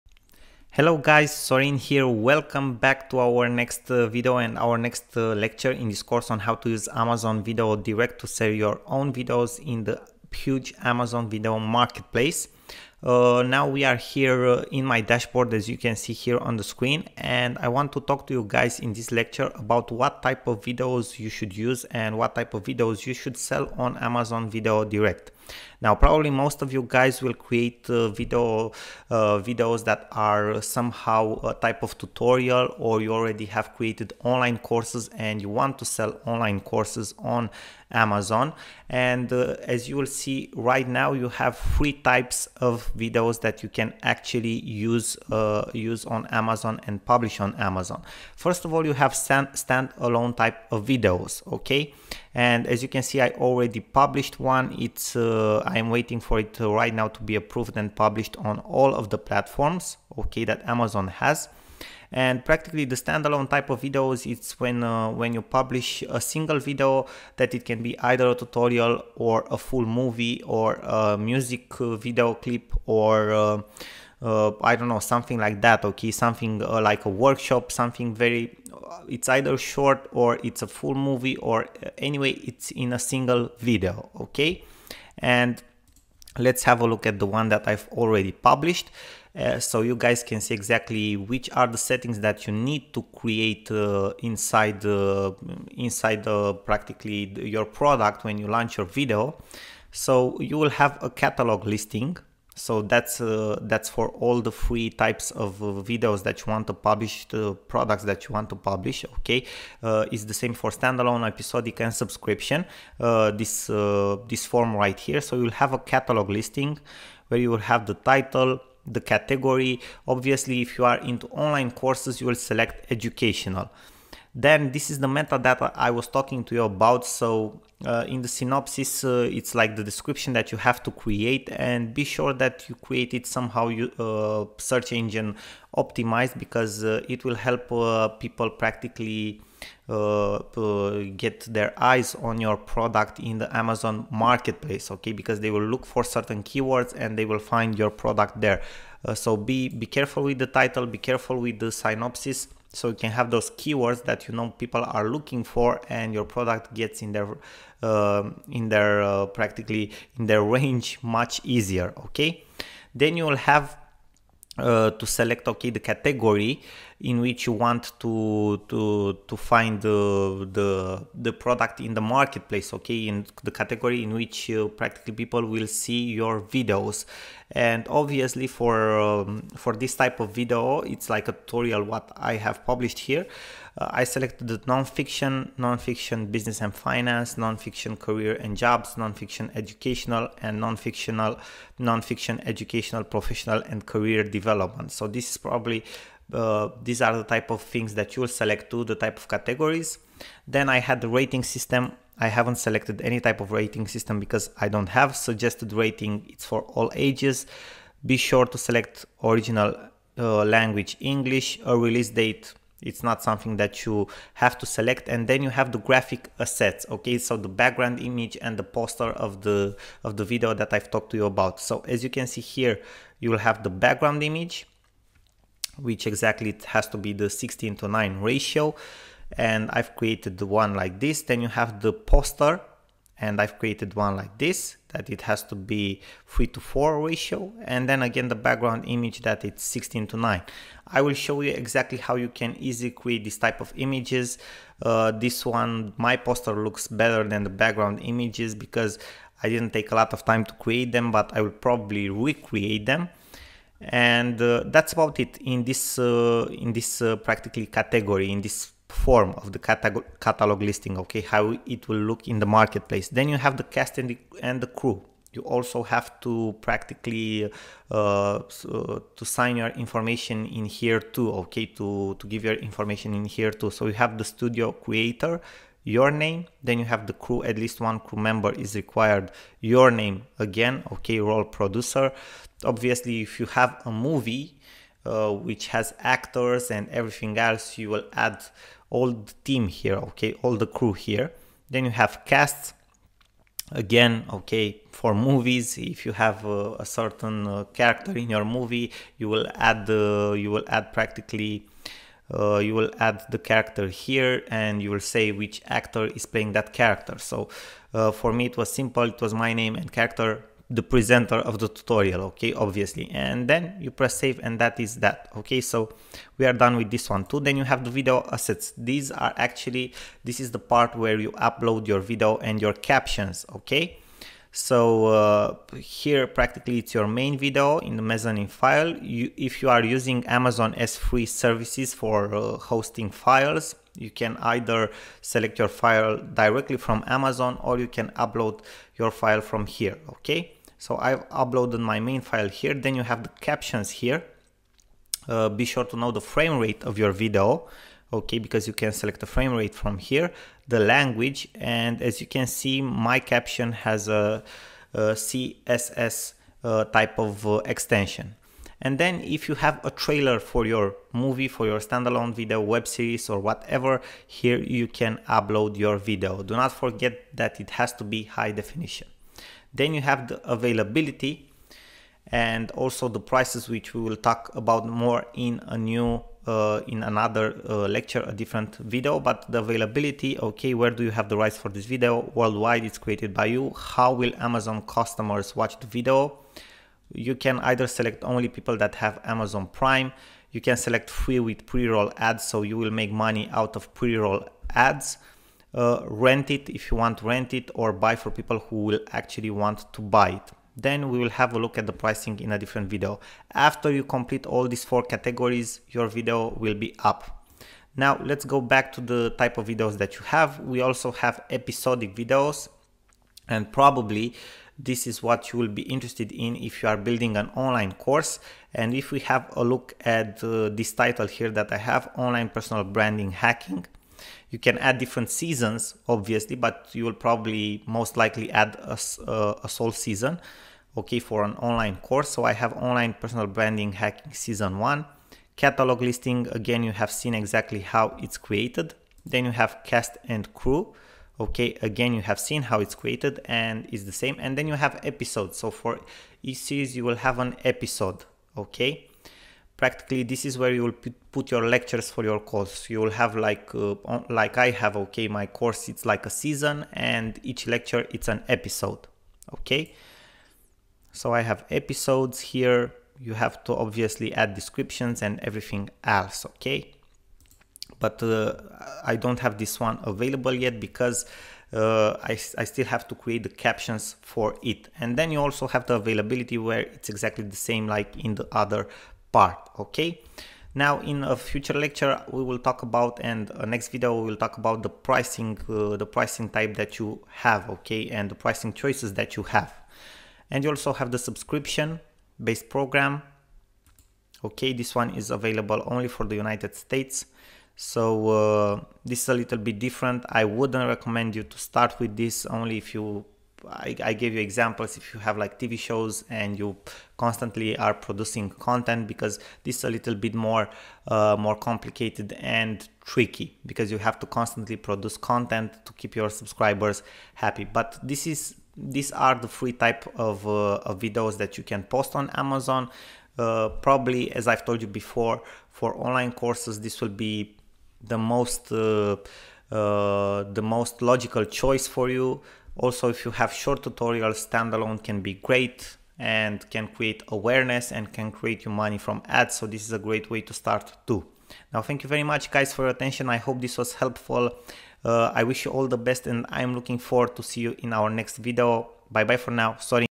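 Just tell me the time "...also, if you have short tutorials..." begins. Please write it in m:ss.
8:52.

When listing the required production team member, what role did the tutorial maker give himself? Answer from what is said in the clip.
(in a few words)
producer.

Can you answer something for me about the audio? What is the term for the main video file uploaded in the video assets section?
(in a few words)
mezzanine file.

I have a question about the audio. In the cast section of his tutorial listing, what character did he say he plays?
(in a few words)
the presenter.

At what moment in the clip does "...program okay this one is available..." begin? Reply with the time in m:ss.
8:12.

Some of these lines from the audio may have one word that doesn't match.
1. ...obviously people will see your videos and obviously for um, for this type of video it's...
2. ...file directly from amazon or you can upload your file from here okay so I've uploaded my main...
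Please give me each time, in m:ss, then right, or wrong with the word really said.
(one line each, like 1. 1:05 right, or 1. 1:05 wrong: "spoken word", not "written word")
1. 2:54 wrong: "practically", not "obviously"
2. 5:35 right.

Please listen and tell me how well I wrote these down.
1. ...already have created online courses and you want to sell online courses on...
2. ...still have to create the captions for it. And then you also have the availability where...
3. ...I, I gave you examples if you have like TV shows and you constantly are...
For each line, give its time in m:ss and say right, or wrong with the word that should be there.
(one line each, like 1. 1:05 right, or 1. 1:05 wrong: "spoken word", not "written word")
1. 0:33 right
2. 7:52 right
3. 8:23 right.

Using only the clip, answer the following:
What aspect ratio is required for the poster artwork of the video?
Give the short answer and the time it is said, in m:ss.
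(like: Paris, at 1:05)
3 to 4, at 3:56.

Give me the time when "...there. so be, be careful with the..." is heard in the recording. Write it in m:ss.
2:28.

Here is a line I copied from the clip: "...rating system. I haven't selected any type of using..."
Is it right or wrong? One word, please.
wrong.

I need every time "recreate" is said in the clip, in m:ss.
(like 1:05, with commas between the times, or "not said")
4:12.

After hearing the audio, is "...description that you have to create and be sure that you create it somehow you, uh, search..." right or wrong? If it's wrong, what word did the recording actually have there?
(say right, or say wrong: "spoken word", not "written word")
right.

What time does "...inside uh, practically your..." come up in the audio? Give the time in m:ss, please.
1:35.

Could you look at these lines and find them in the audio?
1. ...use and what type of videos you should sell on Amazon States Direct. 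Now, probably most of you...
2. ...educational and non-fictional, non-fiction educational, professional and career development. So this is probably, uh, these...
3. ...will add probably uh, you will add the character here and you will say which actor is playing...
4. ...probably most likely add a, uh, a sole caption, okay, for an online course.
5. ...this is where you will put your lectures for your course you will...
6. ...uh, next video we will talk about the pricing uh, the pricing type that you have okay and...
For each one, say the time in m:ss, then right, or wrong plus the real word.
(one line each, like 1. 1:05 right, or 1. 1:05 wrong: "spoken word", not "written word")
1. 0:21 wrong: "Video", not "States"
2. 3:09 right
3. 5:00 wrong: "practically", not "probably"
4. 7:07 wrong: "season", not "caption"
5. 7:30 right
6. 8:03 right.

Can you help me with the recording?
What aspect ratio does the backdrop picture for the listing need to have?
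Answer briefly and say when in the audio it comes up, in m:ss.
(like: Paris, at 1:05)
16 to 9, at 3:47.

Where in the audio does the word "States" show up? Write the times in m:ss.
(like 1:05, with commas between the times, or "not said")
8:16.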